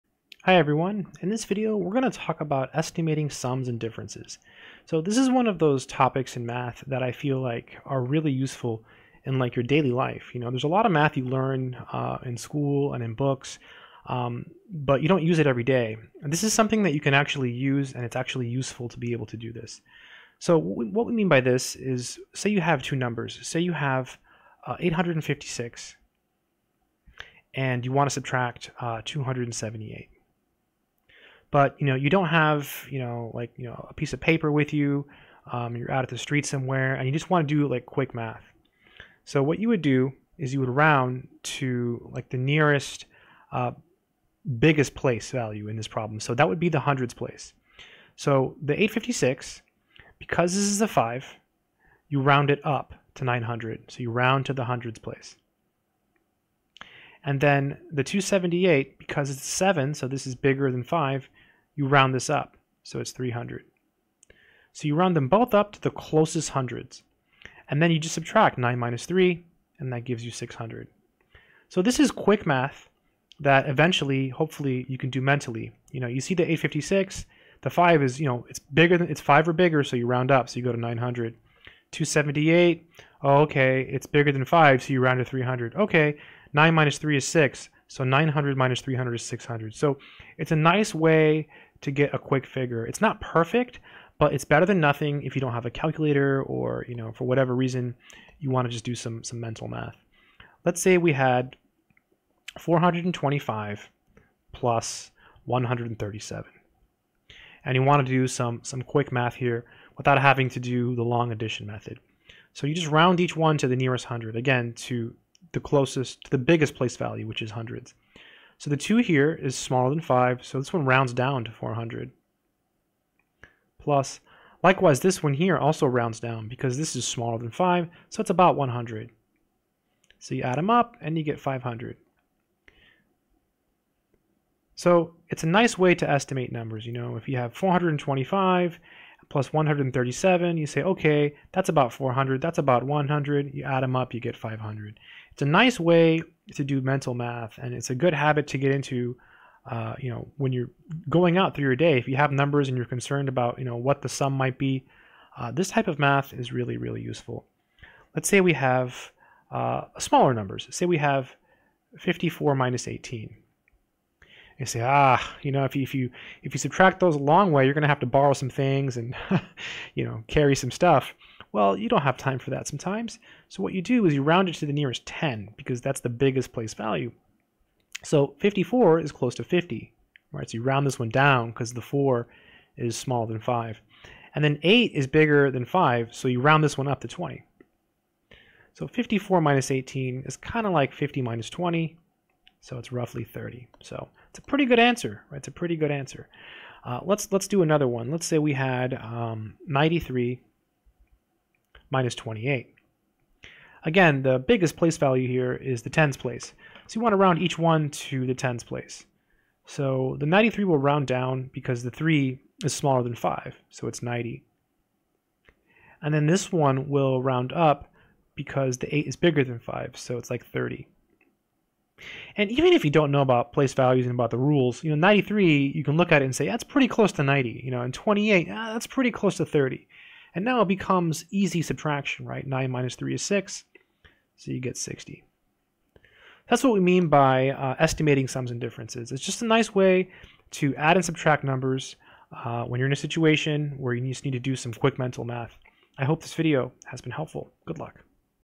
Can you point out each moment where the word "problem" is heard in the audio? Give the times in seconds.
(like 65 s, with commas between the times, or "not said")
45 s.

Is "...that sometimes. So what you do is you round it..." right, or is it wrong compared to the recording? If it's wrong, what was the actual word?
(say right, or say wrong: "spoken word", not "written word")
right.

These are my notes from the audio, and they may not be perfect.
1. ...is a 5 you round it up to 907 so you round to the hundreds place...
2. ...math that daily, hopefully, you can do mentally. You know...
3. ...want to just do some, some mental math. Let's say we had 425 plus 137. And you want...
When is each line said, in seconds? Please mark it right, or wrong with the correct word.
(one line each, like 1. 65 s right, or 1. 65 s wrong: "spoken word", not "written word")
1. 50 s wrong: "900", not "907"
2. 72 s wrong: "eventually", not "daily"
3. 98 s right.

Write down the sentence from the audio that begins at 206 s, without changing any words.
So you want to round each one to the tens place.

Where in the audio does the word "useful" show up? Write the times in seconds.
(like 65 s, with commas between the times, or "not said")
8 s, 18 s, 157 s.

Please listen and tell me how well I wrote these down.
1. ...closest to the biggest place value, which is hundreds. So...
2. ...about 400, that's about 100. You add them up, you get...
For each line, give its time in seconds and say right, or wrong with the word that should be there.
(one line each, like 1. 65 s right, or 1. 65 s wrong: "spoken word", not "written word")
1. 115 s right
2. 141 s right.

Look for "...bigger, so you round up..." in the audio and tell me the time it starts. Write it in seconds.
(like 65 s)
79 s.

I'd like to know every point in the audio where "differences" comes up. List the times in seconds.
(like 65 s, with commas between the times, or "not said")
3 s, 238 s.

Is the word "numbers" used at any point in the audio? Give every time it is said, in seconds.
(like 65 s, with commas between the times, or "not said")
22 s, 136 s, 152 s, 160 s, 241 s.